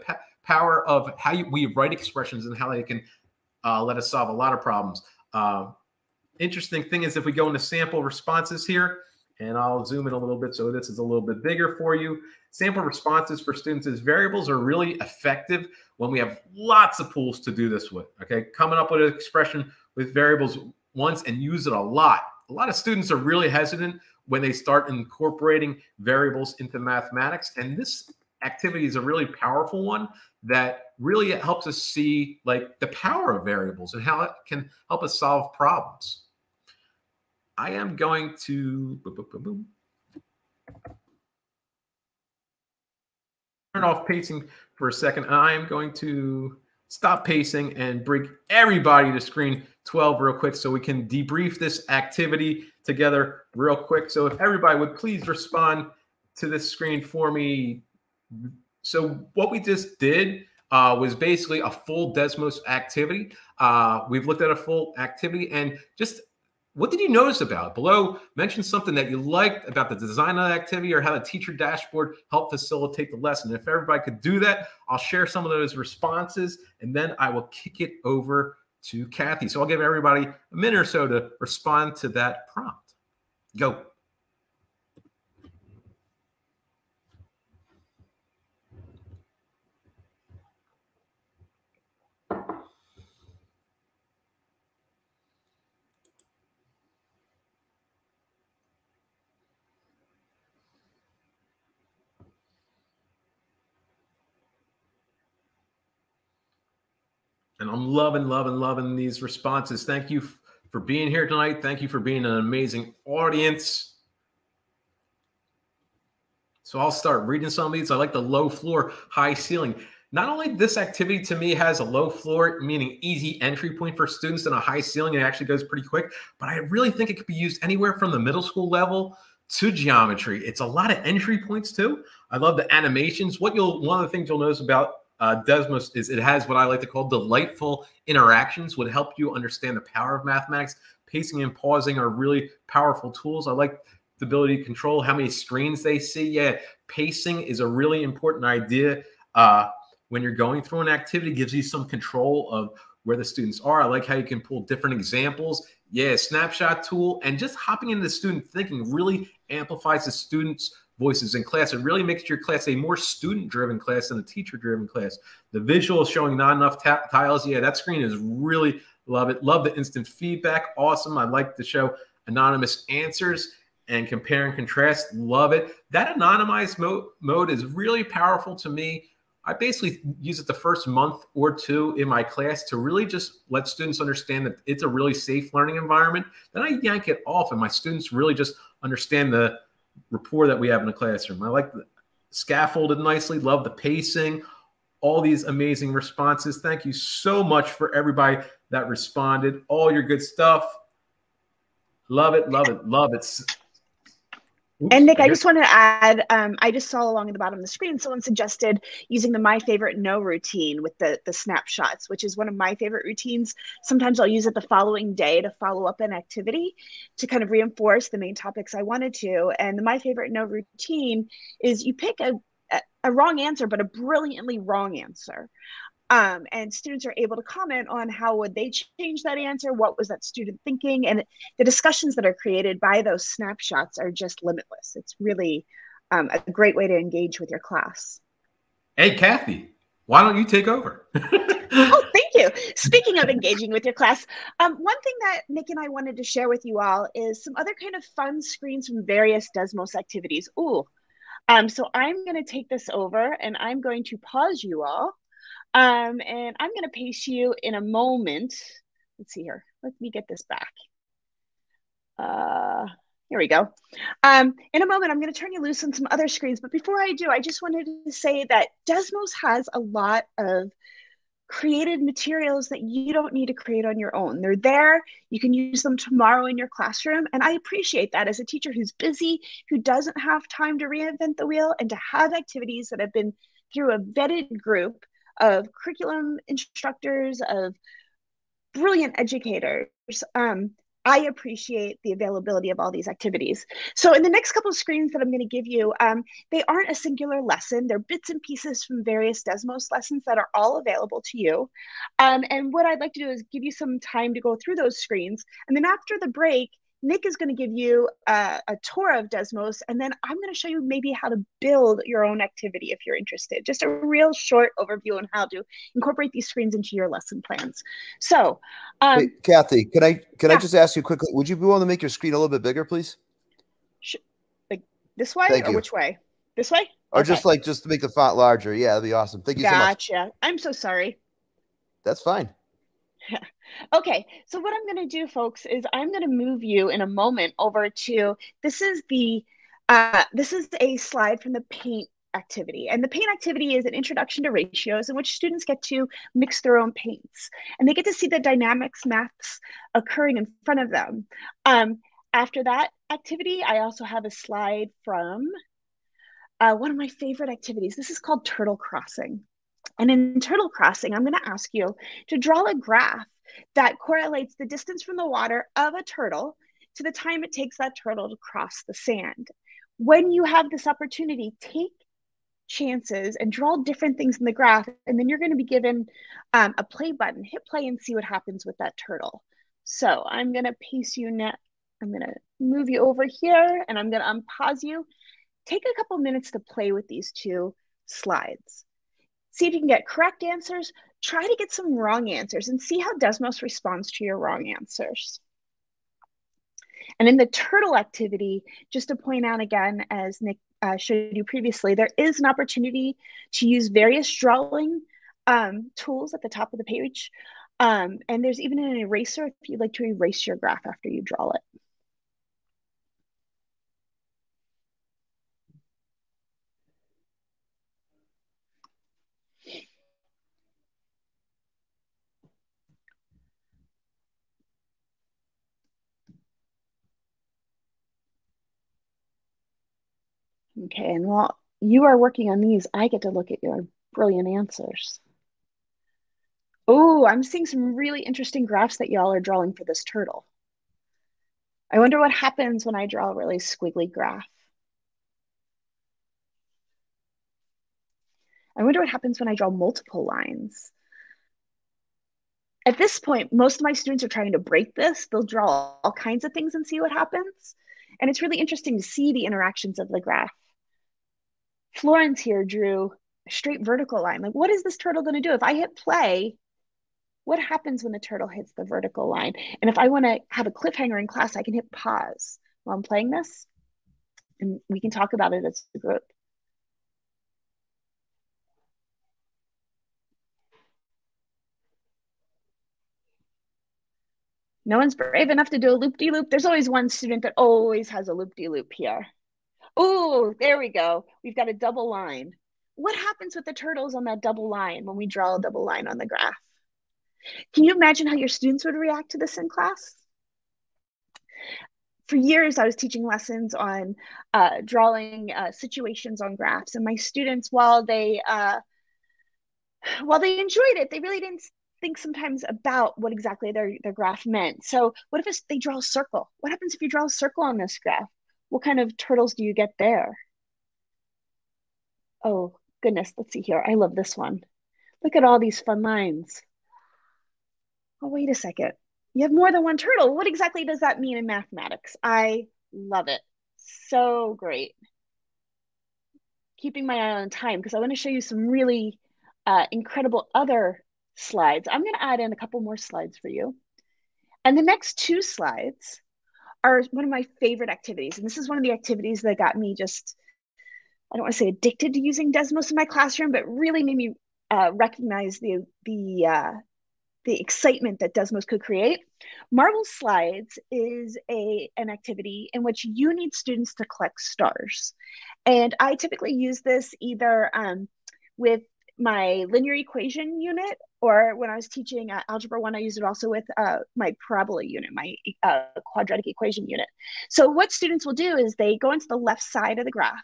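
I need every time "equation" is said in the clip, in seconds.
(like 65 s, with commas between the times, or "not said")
569 s, 576 s.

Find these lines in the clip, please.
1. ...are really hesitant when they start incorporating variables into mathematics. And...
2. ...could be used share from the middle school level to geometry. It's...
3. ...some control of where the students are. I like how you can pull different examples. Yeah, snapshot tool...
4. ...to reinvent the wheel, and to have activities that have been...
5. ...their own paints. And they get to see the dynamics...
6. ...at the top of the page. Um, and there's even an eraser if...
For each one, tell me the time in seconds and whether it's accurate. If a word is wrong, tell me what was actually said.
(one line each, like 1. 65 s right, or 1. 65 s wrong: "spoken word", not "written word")
1. 23 s right
2. 127 s wrong: "anywhere", not "share"
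3. 151 s right
4. 280 s right
5. 346 s right
6. 406 s right.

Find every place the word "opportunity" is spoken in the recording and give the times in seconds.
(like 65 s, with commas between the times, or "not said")
370 s, 402 s.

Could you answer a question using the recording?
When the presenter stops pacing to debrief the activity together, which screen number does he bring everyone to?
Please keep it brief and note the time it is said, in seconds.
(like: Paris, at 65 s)
12, at 49 s.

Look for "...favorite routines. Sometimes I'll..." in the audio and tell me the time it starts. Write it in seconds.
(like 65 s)
212 s.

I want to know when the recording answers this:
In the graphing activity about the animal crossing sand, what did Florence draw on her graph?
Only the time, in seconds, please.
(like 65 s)
463 s.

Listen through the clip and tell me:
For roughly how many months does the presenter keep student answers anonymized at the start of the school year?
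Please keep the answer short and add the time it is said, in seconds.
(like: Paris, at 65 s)
2, at 180 s.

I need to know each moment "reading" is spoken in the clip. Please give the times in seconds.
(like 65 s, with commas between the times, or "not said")
117 s.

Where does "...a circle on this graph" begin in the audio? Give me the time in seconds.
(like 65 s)
517 s.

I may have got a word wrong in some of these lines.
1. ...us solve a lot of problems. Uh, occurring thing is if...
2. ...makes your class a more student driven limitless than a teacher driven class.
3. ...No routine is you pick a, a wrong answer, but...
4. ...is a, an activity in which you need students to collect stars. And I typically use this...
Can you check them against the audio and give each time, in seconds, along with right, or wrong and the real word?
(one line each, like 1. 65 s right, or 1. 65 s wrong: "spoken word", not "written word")
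1. 3 s wrong: "interesting", not "occurring"
2. 162 s wrong: "class", not "limitless"
3. 220 s right
4. 560 s right.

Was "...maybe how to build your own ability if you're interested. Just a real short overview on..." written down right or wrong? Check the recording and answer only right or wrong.
wrong.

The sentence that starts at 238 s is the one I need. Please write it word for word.
Hey, Kathy, why don't you take over?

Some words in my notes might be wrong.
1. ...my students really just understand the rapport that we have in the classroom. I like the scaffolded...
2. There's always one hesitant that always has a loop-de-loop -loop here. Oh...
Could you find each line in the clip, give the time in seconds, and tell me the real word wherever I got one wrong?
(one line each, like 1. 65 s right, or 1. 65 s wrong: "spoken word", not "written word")
1. 187 s right
2. 486 s wrong: "student", not "hesitant".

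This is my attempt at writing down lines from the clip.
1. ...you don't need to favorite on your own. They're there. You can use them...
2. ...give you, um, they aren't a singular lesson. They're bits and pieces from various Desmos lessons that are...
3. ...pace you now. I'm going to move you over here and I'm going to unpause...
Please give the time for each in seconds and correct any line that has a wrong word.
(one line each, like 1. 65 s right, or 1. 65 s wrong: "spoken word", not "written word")
1. 272 s wrong: "create", not "favorite"
2. 295 s right
3. 380 s right.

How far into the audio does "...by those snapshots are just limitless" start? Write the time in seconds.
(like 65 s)
232 s.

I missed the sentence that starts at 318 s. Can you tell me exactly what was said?
So, um, Wait, Kathy, can I can yeah.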